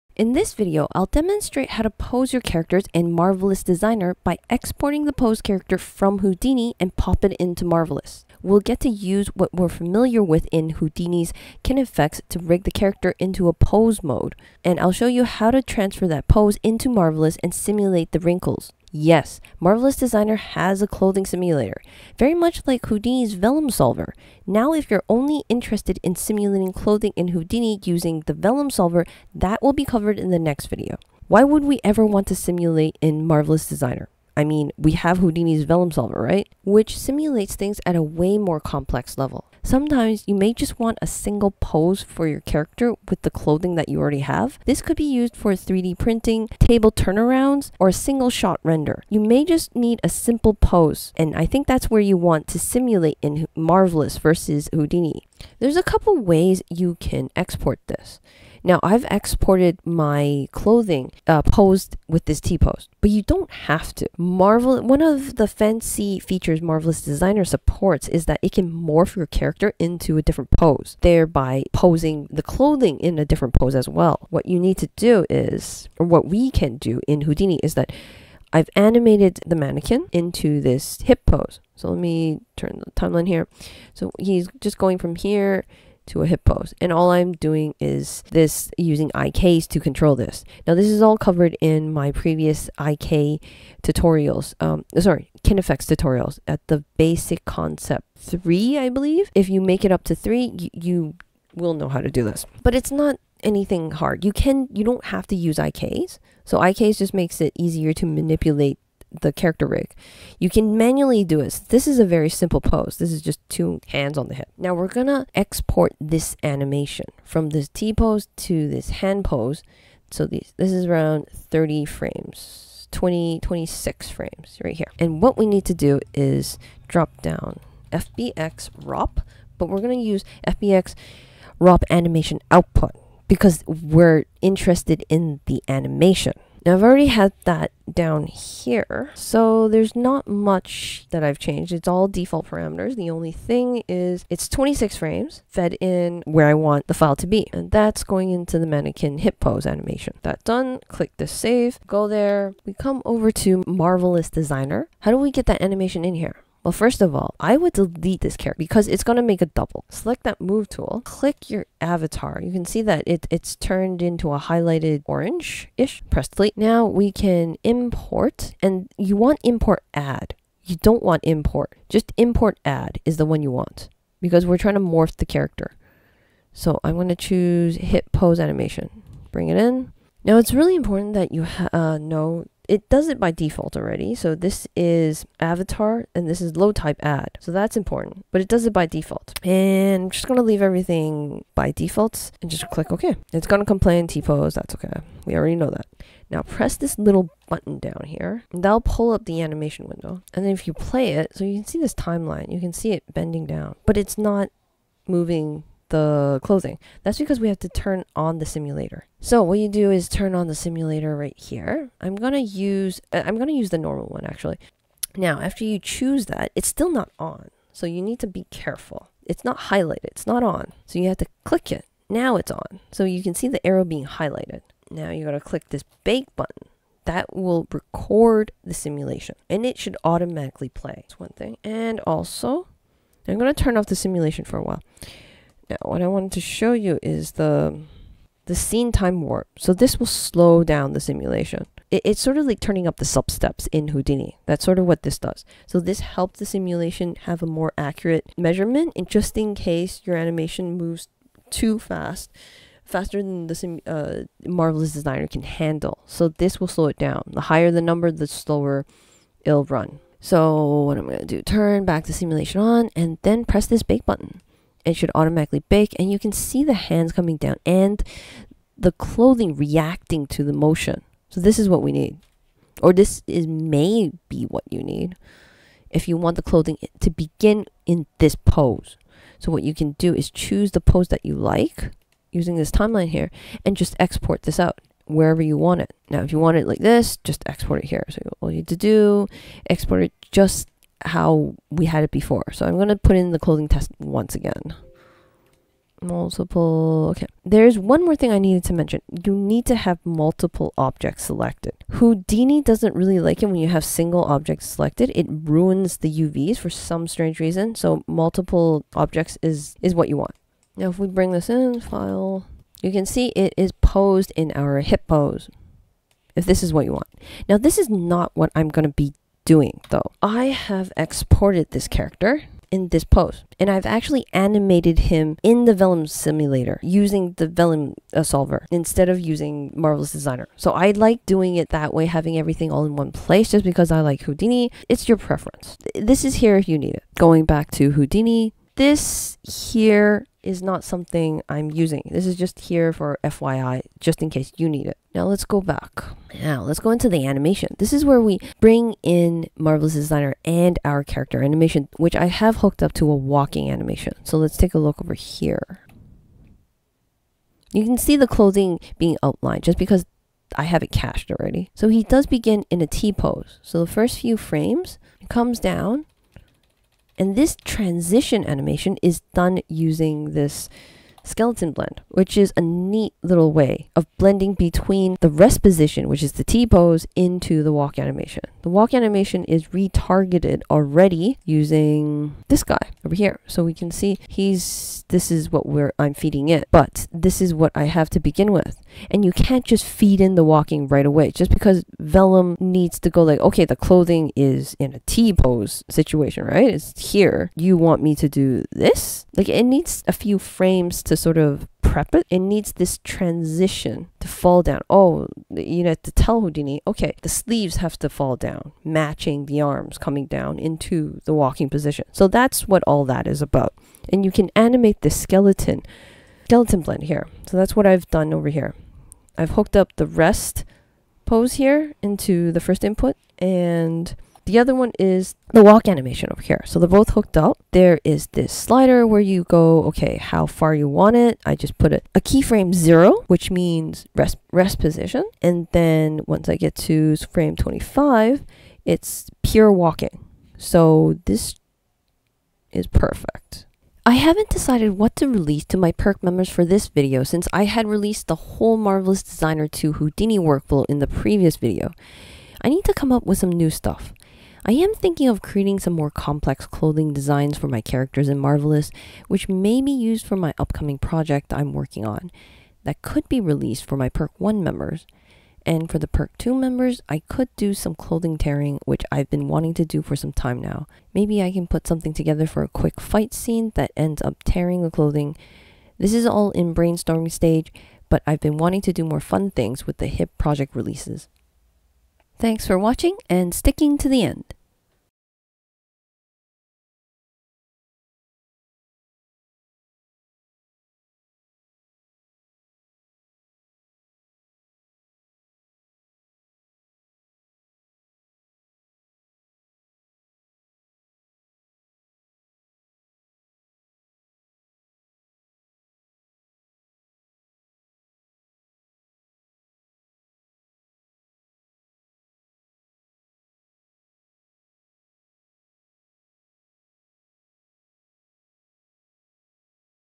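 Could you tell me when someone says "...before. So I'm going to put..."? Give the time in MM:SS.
04:52.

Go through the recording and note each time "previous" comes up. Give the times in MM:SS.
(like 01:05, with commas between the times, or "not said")
01:32, 07:31.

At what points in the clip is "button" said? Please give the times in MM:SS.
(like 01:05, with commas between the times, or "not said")
03:17, 03:46, 04:24.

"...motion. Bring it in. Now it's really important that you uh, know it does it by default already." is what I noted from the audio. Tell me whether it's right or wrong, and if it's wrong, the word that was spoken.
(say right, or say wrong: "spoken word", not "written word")
wrong: "animation", not "motion".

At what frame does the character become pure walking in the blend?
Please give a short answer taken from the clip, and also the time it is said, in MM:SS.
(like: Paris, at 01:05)
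25, at 07:17.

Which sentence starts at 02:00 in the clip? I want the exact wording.
So these, this is around 30 frames, 20, 26 frames right here.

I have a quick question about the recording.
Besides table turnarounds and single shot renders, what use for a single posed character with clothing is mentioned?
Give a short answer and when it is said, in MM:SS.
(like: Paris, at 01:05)
3D printing, at 00:45.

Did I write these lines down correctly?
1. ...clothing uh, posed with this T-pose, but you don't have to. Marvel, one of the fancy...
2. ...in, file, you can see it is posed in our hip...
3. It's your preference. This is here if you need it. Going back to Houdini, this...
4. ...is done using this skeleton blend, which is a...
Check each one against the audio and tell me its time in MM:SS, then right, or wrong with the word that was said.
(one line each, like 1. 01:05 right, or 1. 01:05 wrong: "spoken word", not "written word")
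1. 01:00 right
2. 05:11 right
3. 05:34 right
4. 06:09 right.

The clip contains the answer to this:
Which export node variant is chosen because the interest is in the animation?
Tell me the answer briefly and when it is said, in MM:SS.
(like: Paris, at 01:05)
FBX ROP animation output, at 02:10.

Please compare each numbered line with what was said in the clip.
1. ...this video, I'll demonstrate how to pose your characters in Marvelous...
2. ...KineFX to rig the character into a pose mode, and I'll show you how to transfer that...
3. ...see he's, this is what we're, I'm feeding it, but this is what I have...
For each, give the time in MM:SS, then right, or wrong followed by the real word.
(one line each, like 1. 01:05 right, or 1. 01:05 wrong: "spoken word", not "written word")
1. 00:00 right
2. 00:11 right
3. 06:23 right.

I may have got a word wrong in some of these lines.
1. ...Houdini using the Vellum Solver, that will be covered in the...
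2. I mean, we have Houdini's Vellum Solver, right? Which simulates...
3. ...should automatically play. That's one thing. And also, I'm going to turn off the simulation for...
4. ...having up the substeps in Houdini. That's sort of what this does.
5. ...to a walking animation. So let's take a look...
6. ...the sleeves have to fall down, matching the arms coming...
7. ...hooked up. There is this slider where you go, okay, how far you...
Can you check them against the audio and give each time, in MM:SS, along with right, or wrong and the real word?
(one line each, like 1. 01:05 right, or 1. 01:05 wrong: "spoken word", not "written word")
1. 00:27 right
2. 00:34 right
3. 03:49 right
4. 04:02 wrong: "turning", not "having"
5. 05:52 right
6. 06:47 right
7. 07:07 right.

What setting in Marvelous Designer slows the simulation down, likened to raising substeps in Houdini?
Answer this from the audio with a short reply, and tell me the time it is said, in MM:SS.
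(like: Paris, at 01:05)
scene time warp, at 03:58.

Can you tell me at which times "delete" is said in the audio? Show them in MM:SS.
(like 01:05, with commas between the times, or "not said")
02:37, 02:46.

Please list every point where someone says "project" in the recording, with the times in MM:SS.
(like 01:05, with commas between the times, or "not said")
07:40, 08:00.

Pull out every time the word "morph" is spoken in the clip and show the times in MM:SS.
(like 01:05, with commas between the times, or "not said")
01:08, 02:54.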